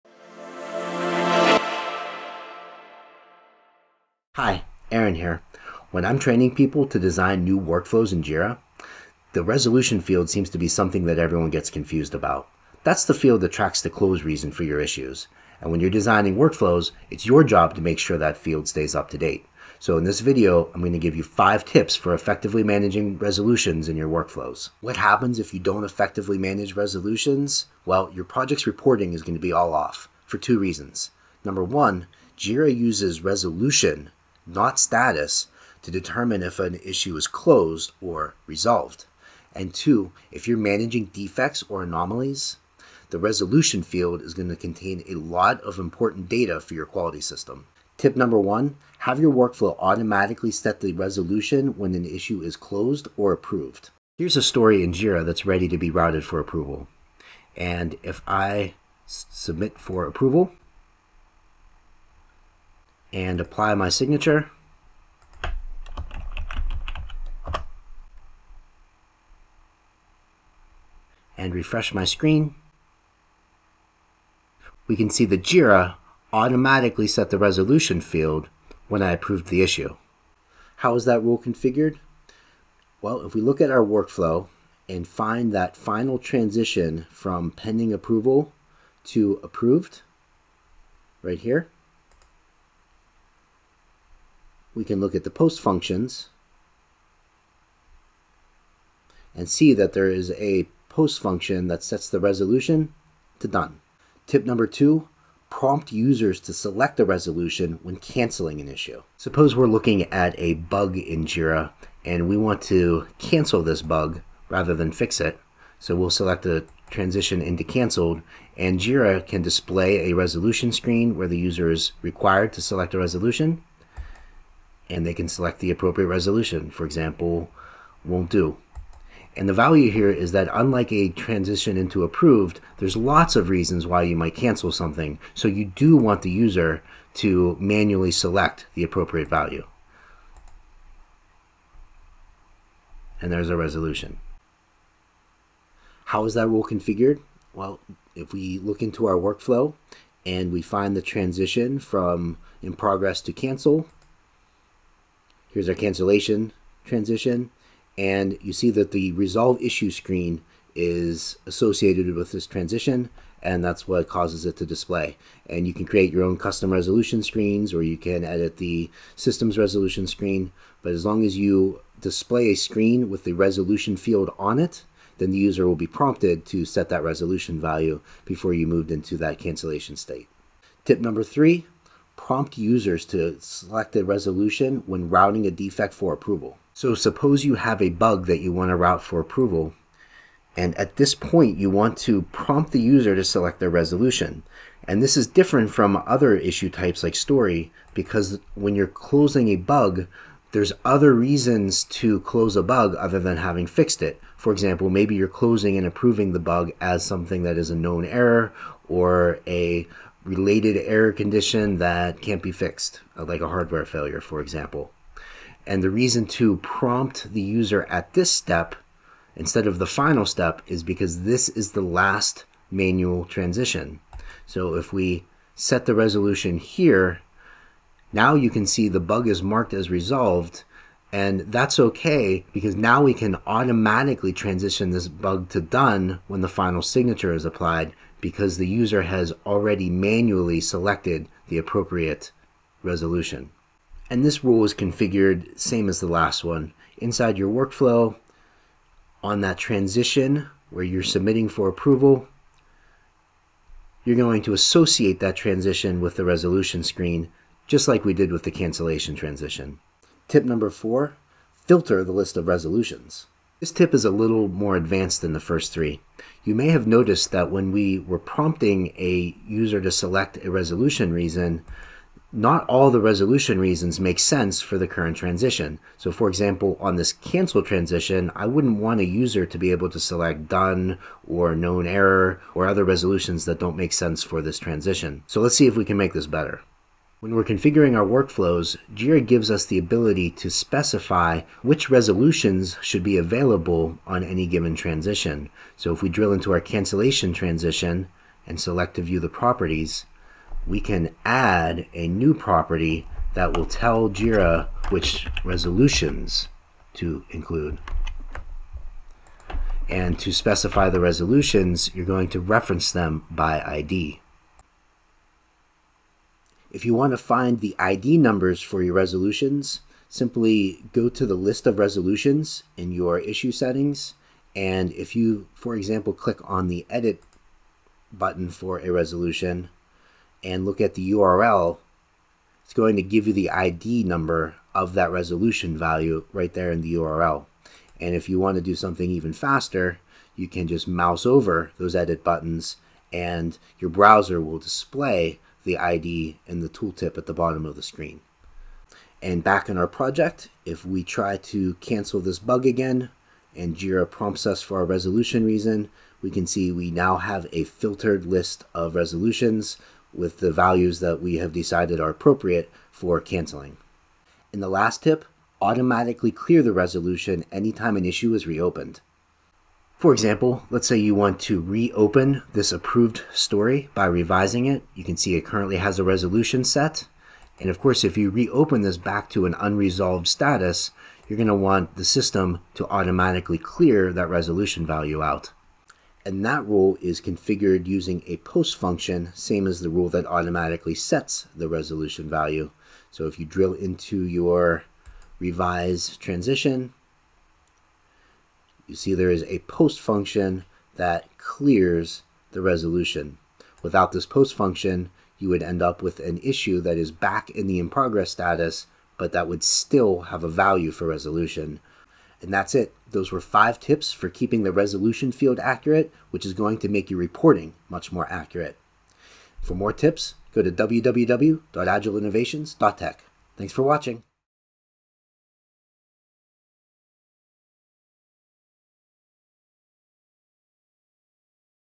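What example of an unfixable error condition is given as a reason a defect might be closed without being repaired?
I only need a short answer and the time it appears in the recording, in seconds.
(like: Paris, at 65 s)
Hardware failure, at 213 s.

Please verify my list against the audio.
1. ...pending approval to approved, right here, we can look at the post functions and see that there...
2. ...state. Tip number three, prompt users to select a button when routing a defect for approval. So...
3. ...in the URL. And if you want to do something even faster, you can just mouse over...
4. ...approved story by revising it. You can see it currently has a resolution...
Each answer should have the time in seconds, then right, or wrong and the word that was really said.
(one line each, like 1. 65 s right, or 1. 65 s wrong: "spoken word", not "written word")
1. 87 s right
2. 179 s wrong: "resolution", not "button"
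3. 336 s right
4. 372 s right.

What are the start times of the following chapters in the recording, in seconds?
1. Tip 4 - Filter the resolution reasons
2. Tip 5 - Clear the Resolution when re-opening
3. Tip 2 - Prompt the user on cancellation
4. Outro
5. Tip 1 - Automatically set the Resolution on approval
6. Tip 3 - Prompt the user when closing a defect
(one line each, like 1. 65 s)
1. 260 s
2. 364 s
3. 103 s
4. 412 s
5. 48 s
6. 180 s.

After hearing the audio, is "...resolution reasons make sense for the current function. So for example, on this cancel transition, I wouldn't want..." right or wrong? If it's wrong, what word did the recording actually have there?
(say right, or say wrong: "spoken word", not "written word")
wrong: "transition", not "function".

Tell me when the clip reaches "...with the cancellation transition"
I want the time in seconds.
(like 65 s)
258 s.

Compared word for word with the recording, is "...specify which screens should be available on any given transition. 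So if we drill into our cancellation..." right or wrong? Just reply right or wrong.
wrong.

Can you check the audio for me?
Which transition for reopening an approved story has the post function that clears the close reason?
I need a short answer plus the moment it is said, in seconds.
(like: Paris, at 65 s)
Revise, at 395 s.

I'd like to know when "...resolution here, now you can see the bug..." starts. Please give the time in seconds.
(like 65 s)
225 s.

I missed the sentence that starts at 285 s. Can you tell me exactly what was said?
So let's see if we can make this better.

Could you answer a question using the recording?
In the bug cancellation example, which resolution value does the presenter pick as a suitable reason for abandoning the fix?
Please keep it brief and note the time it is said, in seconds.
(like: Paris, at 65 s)
Won't do, at 128 s.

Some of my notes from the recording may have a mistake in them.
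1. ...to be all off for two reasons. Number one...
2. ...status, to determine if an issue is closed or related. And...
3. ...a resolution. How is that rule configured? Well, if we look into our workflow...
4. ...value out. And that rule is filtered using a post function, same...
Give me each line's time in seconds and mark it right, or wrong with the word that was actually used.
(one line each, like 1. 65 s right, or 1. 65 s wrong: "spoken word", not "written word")
1. 29 s right
2. 34 s wrong: "resolved", not "related"
3. 143 s right
4. 384 s wrong: "configured", not "filtered".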